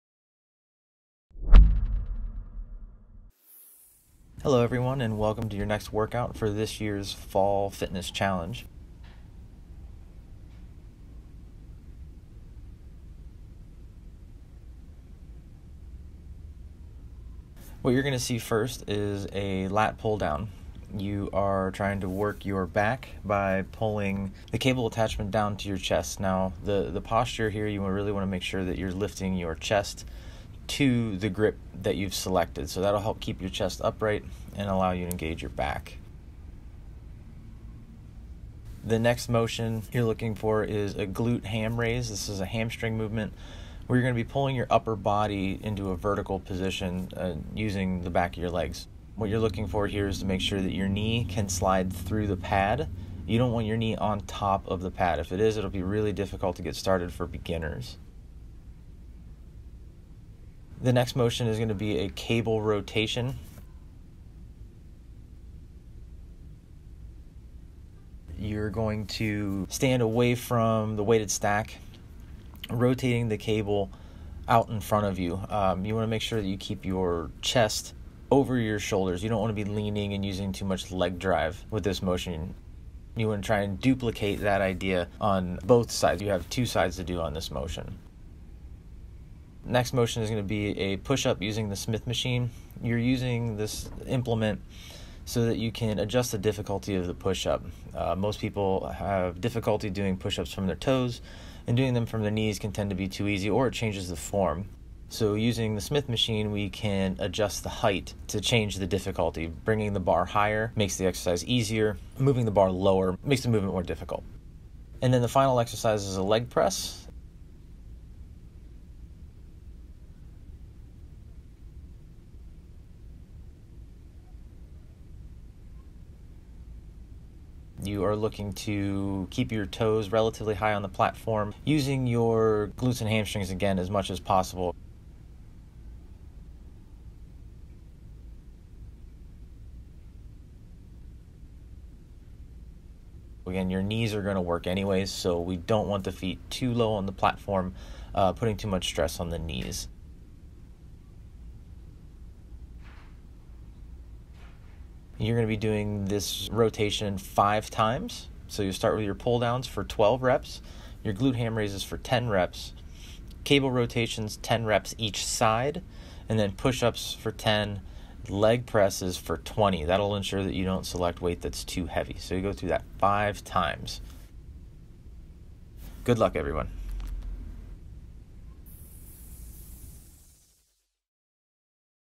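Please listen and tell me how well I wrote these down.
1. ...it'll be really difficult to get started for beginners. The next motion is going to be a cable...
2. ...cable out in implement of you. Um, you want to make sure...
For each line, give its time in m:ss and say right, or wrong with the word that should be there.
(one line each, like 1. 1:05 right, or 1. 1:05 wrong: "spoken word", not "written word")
1. 0:55 right
2. 1:13 wrong: "front", not "implement".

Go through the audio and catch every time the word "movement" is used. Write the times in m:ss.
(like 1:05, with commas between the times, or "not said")
0:42, 1:53.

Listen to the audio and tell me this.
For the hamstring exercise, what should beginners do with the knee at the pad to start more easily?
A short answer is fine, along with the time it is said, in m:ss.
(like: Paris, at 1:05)
slide through the pad, at 0:51.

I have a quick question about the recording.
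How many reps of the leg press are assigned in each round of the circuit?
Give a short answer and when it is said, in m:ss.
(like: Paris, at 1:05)
20, at 2:48.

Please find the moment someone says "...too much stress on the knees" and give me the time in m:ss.
2:28.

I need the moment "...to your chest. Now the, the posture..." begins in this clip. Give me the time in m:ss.
0:25.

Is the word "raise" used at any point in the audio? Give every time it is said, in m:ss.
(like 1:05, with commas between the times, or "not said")
0:41, 2:41.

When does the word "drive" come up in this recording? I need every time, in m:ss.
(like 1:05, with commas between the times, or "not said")
1:21.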